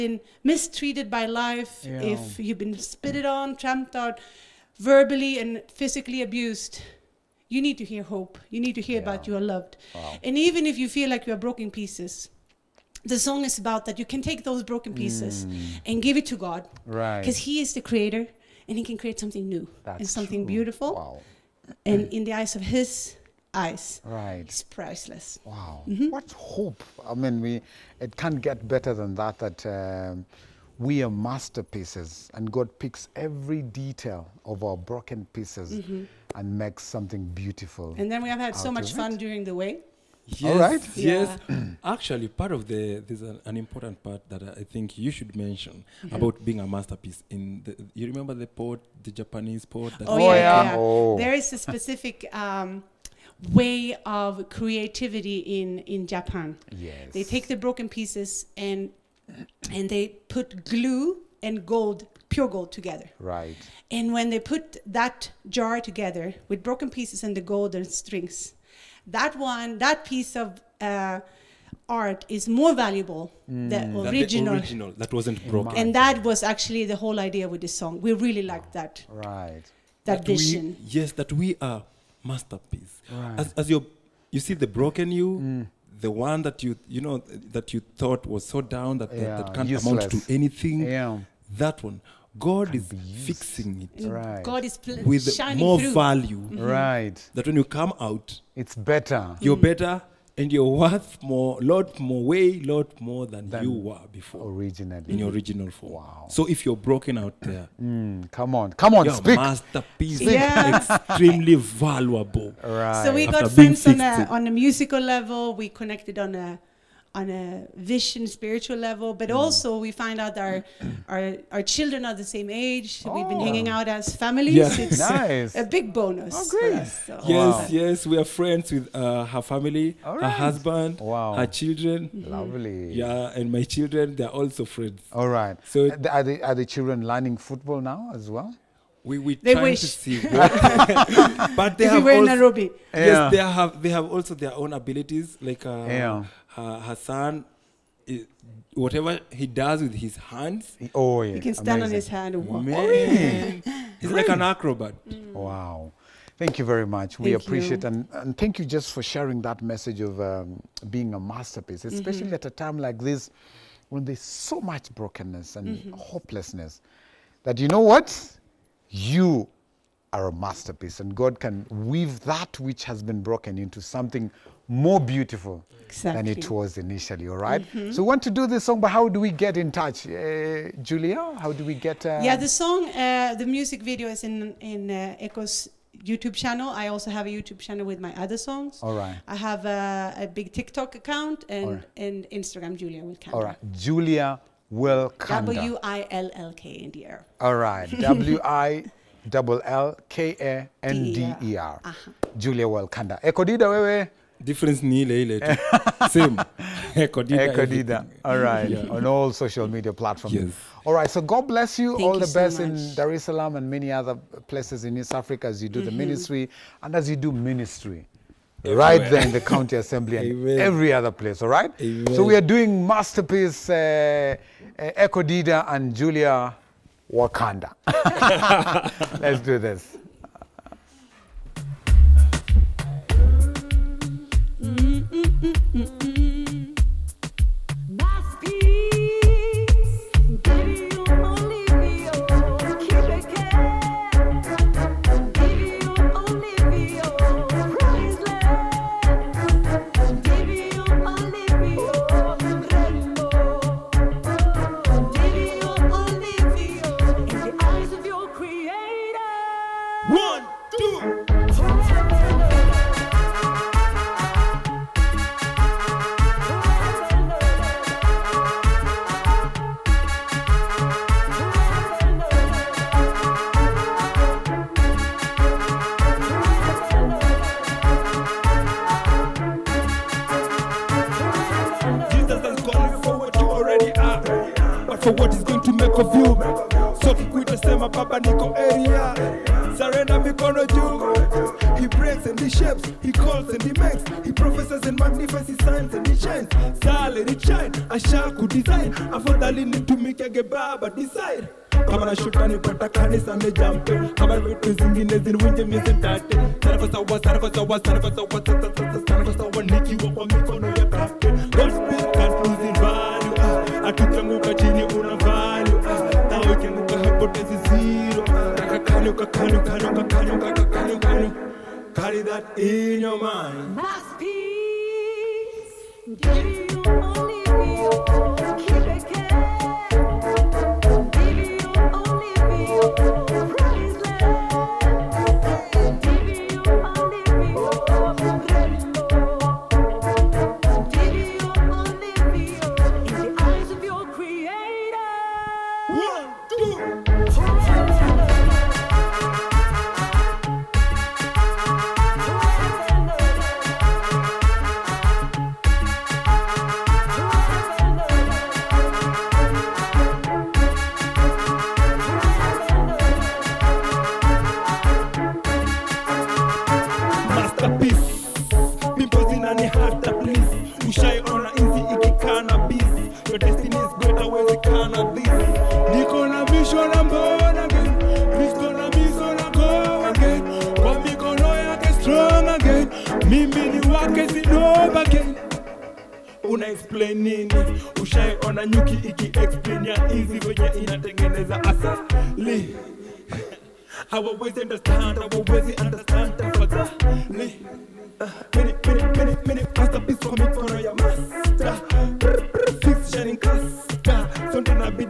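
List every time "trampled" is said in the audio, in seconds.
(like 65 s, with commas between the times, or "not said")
3 s.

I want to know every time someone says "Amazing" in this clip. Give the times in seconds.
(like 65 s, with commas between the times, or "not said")
151 s.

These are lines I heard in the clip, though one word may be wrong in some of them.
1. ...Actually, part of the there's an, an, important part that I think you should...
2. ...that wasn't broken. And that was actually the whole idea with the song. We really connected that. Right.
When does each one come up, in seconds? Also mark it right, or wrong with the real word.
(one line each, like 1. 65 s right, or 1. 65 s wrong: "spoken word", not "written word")
1. 41 s right
2. 74 s wrong: "liked", not "connected".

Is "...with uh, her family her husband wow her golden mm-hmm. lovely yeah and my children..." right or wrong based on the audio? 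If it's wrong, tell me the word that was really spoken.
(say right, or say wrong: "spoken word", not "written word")
wrong: "children", not "golden".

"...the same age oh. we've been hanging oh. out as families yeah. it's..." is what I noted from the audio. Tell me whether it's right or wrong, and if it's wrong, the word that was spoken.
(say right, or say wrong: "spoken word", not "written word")
right.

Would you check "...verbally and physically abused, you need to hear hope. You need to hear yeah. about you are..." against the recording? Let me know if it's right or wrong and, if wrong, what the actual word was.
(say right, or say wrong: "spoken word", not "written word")
right.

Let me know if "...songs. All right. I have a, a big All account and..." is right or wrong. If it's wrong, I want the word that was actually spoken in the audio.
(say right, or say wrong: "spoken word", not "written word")
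wrong: "TikTok", not "All".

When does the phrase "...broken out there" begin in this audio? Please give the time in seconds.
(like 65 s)
106 s.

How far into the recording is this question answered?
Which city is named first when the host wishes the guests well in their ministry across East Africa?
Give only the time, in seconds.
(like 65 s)
212 s.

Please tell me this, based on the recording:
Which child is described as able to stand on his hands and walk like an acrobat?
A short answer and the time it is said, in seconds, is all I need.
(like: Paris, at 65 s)
Hassan, at 146 s.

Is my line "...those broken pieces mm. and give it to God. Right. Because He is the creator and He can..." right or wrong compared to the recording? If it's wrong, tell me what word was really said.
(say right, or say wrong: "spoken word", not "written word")
right.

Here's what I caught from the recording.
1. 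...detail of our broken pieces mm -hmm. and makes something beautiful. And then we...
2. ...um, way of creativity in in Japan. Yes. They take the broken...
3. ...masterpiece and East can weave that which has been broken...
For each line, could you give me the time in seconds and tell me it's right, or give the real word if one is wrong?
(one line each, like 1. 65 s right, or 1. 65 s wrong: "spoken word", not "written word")
1. 33 s right
2. 52 s right
3. 170 s wrong: "God", not "East".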